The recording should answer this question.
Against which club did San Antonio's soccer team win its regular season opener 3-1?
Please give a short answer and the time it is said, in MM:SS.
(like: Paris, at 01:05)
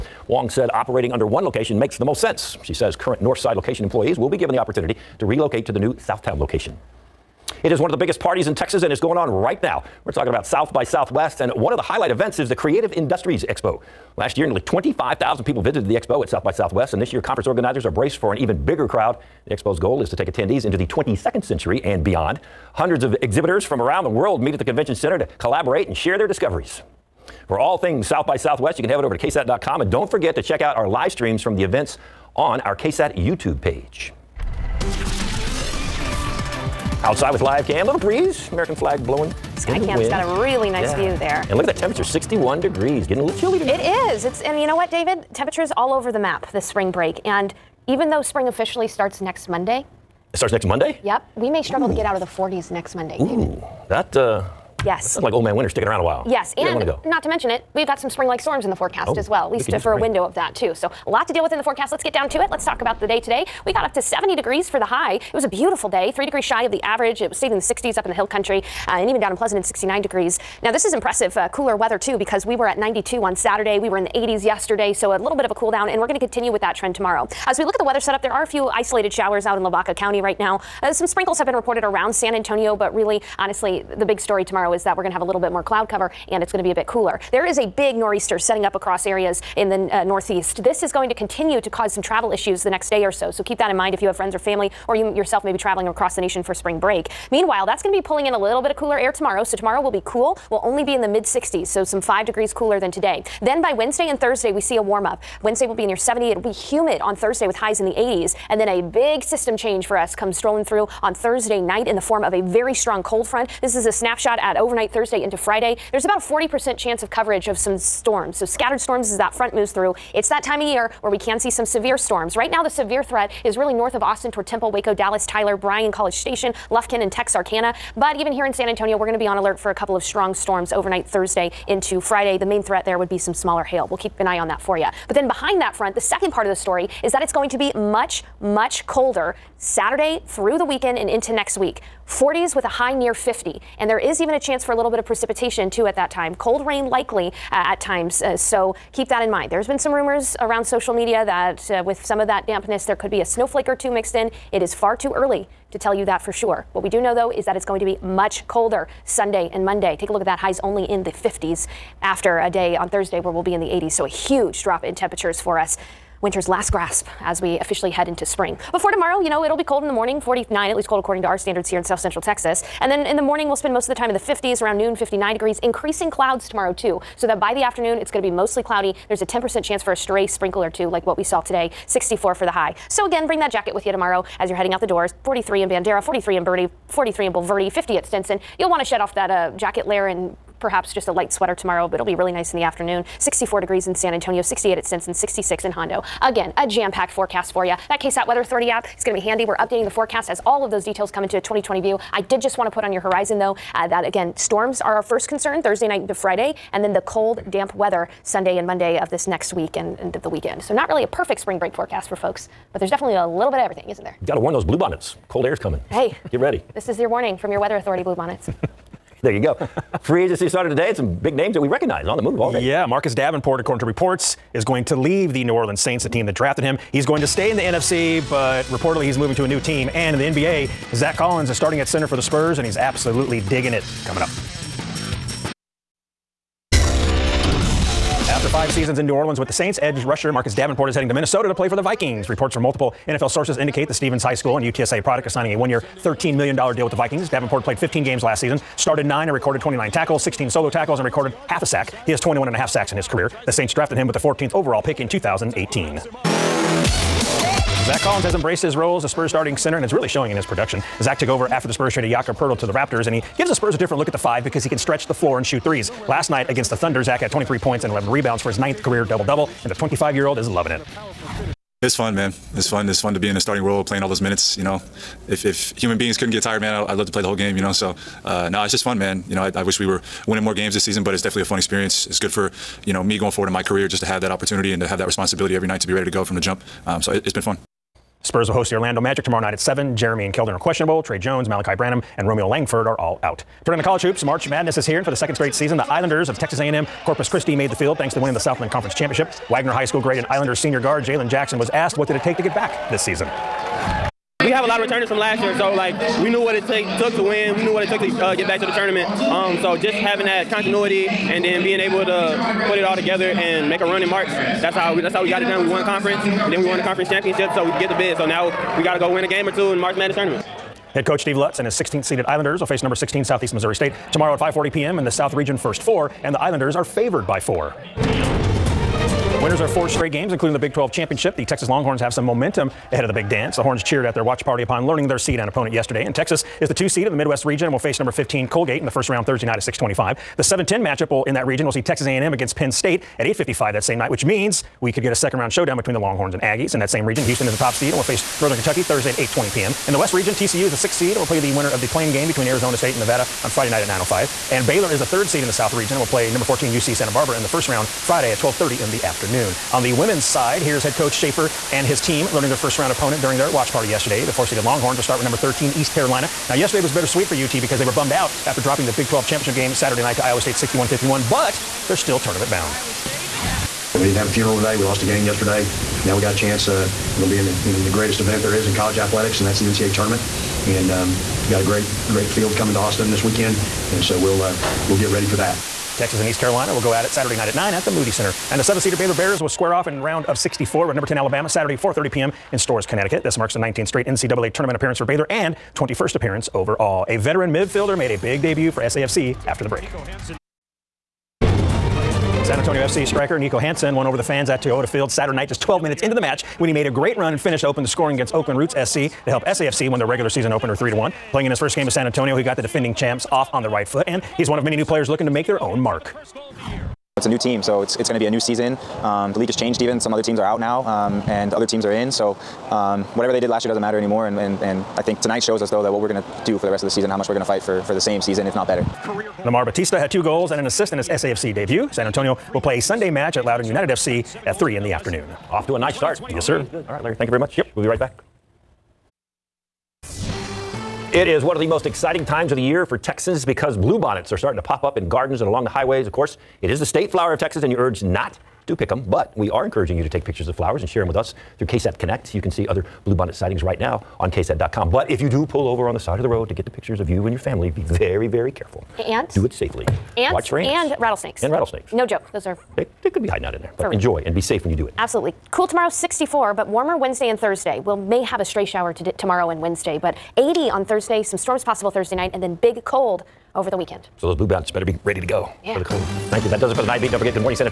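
Oakland Roots SC, at 06:48.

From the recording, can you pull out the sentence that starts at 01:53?
This is a snapshot at overnight Thursday into Friday.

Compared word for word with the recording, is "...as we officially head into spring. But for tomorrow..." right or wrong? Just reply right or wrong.
right.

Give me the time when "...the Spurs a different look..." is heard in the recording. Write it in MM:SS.
04:23.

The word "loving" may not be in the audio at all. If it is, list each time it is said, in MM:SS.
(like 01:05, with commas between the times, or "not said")
04:30.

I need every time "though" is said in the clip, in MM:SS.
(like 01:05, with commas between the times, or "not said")
00:48, 02:37, 03:23, 07:05.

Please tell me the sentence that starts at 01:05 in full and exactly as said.
It was a beautiful day, three degrees shy of the average.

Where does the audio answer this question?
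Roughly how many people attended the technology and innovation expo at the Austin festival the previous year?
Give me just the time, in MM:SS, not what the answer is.
00:14.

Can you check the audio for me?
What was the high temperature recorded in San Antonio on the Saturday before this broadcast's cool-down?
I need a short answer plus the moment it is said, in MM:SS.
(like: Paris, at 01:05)
92, at 01:12.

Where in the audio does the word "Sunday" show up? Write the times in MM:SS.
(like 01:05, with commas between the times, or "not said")
02:39, 03:28, 07:12.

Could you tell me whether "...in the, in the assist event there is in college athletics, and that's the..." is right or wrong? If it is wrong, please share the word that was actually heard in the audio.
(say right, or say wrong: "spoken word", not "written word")
wrong: "greatest", not "assist".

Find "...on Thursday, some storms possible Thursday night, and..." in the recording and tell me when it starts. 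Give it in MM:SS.
07:50.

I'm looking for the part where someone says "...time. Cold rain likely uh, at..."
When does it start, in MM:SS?
02:26.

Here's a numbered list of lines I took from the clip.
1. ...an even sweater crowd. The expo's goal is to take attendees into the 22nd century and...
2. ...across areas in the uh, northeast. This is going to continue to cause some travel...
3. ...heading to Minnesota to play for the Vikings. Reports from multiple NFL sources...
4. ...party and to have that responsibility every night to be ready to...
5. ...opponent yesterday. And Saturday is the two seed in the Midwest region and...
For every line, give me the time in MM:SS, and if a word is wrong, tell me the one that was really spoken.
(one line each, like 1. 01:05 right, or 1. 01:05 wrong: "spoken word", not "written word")
1. 00:18 wrong: "bigger", not "sweater"
2. 01:28 right
3. 04:00 right
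4. 04:44 wrong: "opportunity", not "party"
5. 05:35 wrong: "Texas", not "Saturday".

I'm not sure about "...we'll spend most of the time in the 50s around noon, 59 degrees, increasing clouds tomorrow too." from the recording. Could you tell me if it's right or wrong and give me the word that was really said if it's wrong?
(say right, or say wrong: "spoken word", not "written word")
right.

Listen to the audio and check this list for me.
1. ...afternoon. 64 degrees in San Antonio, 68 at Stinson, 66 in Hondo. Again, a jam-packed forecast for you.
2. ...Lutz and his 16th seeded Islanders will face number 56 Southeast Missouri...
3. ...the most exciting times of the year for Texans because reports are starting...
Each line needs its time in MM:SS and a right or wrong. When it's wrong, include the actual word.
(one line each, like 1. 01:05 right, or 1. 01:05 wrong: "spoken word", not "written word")
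1. 03:12 right
2. 05:21 wrong: "16", not "56"
3. 07:21 wrong: "bluebonnets", not "reports".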